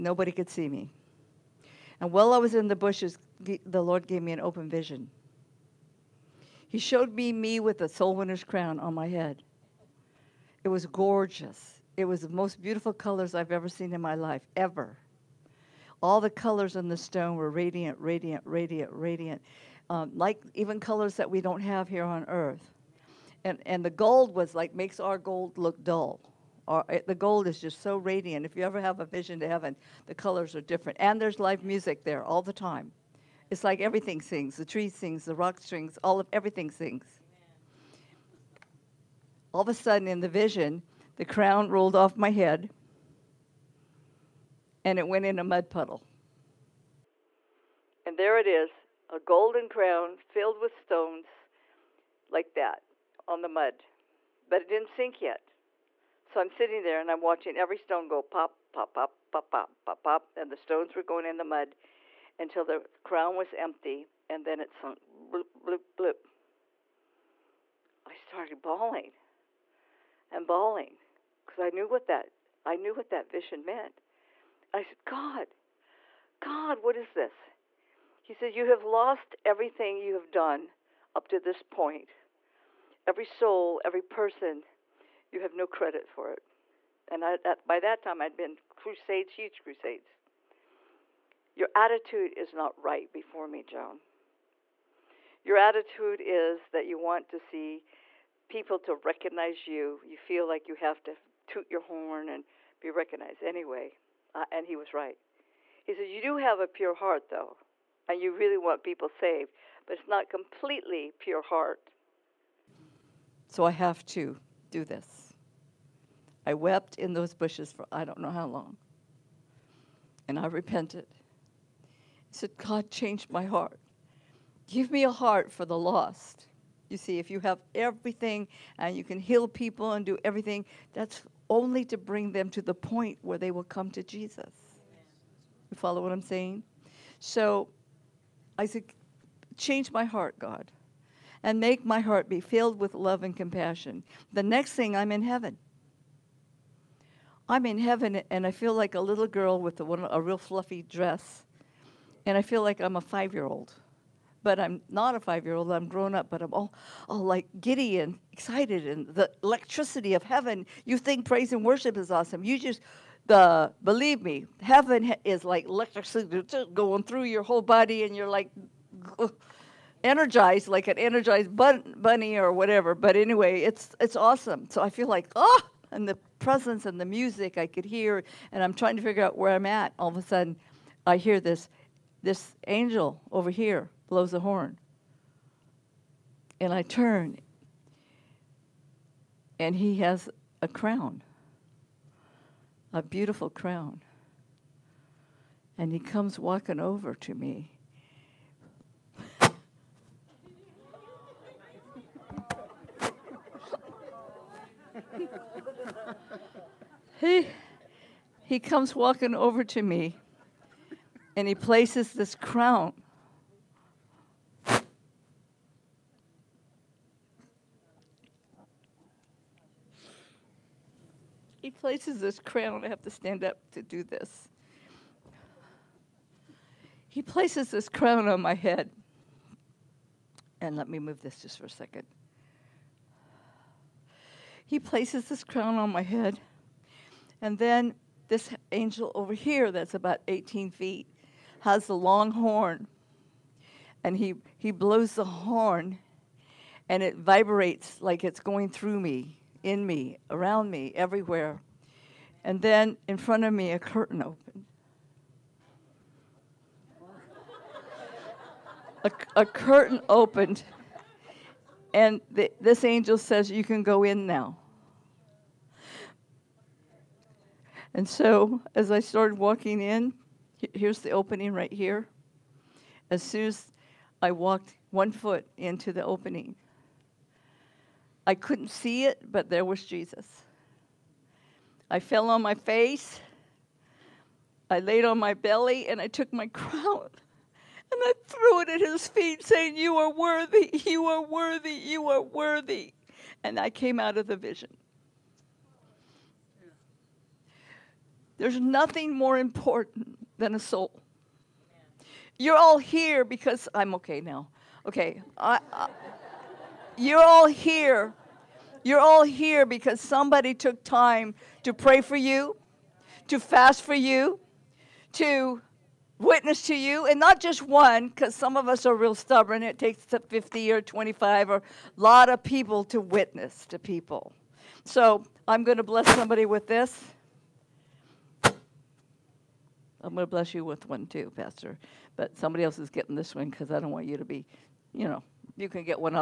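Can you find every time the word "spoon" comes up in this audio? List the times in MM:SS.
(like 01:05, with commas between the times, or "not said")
not said.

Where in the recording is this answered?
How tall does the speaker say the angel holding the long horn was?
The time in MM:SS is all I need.
04:00.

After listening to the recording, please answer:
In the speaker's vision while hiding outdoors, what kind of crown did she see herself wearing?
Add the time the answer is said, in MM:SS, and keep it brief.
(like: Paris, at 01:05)
soul winner's crown, at 00:07.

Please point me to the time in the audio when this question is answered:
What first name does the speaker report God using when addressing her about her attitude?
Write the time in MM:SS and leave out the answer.
01:33.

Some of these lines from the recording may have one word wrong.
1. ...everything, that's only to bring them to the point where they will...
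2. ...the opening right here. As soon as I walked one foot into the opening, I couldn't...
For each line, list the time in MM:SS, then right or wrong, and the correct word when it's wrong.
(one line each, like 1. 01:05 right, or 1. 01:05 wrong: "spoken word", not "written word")
1. 02:10 right
2. 04:30 right.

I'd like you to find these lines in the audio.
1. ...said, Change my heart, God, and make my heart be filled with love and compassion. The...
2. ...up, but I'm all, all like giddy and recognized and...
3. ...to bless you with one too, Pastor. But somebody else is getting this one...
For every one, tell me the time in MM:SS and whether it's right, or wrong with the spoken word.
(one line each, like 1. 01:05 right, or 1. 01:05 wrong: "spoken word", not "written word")
1. 02:18 right
2. 02:36 wrong: "excited", not "recognized"
3. 05:30 right.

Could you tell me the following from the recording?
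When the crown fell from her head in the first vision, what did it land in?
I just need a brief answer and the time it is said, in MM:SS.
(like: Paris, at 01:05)
a mud puddle, at 00:45.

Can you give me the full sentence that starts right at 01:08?
I started bawling and bawling because I knew what that I knew what that vision meant.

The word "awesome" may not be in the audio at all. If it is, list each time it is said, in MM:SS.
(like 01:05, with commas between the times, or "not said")
02:42, 02:54.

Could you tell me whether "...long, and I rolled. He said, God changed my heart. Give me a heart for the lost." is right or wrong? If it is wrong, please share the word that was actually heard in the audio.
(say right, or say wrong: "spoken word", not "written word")
wrong: "repented", not "rolled".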